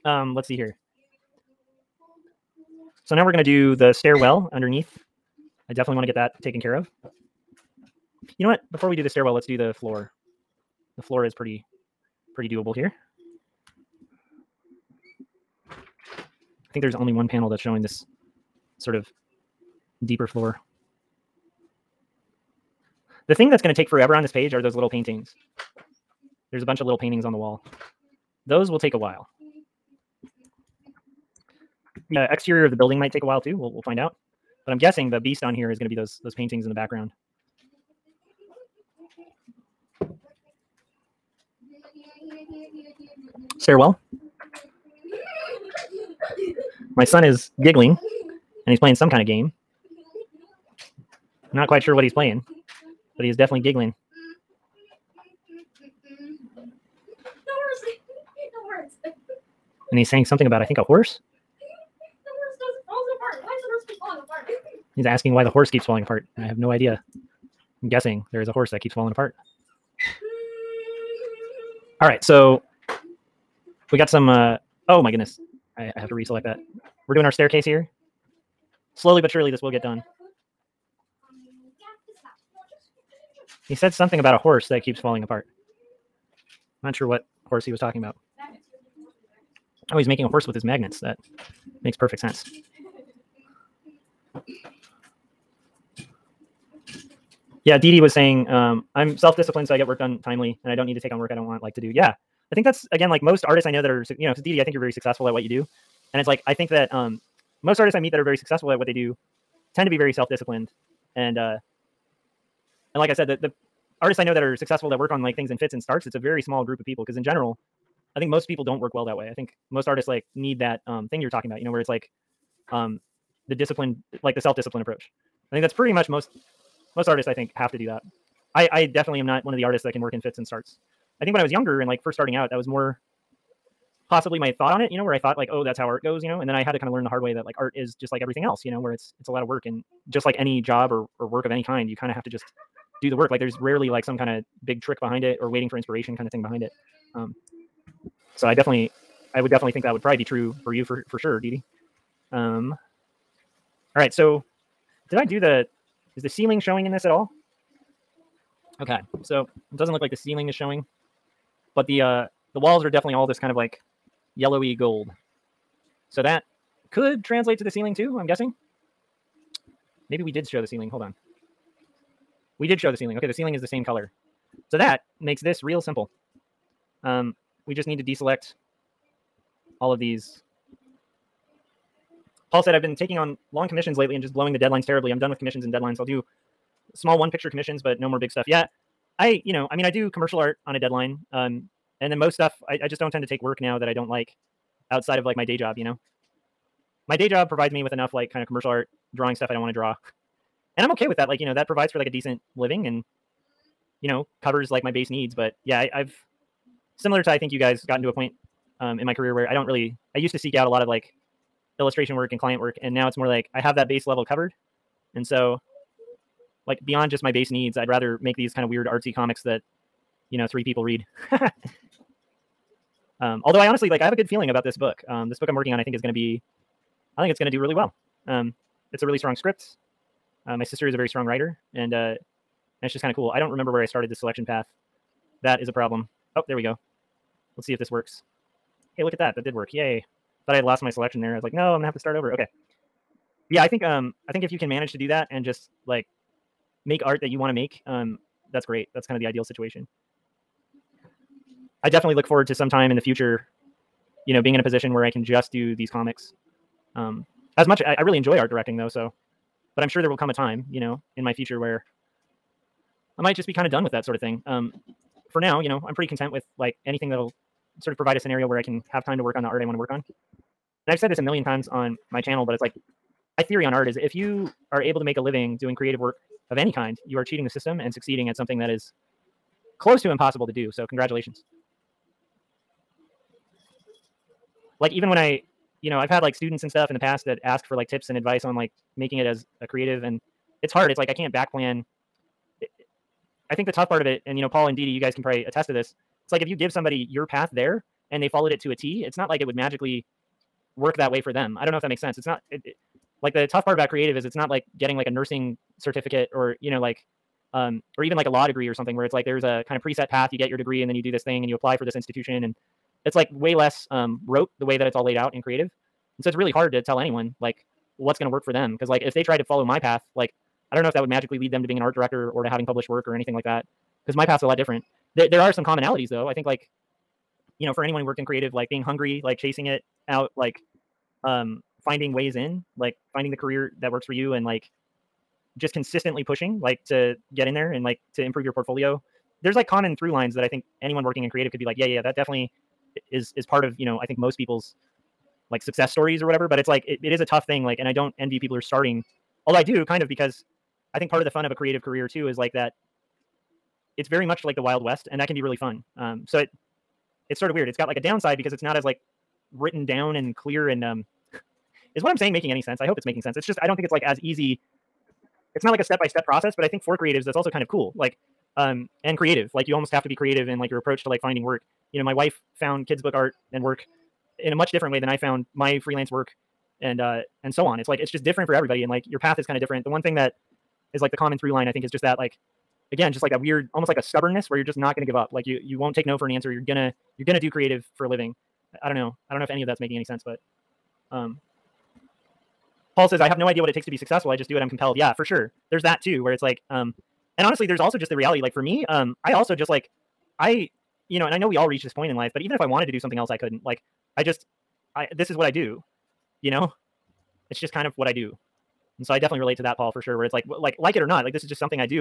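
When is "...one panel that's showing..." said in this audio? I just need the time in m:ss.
0:17.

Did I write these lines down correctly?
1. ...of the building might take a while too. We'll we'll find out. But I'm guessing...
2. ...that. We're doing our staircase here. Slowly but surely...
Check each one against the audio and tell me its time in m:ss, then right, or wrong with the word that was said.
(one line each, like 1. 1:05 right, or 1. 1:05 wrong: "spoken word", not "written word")
1. 0:32 right
2. 1:16 right.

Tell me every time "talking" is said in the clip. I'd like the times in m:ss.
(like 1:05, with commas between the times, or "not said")
1:27, 2:01.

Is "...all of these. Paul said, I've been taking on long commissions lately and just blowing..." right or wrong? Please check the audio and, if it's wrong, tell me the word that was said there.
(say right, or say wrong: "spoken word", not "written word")
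right.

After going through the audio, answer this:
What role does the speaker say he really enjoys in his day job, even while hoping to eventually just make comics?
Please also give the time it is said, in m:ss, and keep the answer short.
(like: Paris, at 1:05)
Art directing, at 4:18.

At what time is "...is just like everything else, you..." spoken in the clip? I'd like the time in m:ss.
2:17.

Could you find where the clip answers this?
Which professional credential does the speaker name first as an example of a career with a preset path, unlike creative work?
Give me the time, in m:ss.
5:05.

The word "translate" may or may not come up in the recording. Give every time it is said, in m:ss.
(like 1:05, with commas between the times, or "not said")
2:47.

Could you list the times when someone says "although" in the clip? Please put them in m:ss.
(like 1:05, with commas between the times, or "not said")
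3:43, 5:49.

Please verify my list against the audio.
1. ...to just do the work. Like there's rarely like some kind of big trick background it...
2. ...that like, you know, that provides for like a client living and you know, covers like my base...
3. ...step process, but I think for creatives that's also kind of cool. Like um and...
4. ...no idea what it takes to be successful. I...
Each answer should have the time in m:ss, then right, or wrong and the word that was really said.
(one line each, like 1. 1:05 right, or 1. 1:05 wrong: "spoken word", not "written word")
1. 2:22 wrong: "behind", not "background"
2. 3:21 wrong: "decent", not "client"
3. 6:06 right
4. 6:33 right.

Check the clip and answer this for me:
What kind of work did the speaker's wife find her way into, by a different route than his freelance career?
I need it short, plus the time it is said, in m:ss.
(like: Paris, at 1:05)
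Kids book art, at 6:12.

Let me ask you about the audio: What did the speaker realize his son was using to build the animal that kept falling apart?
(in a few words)
Magnets.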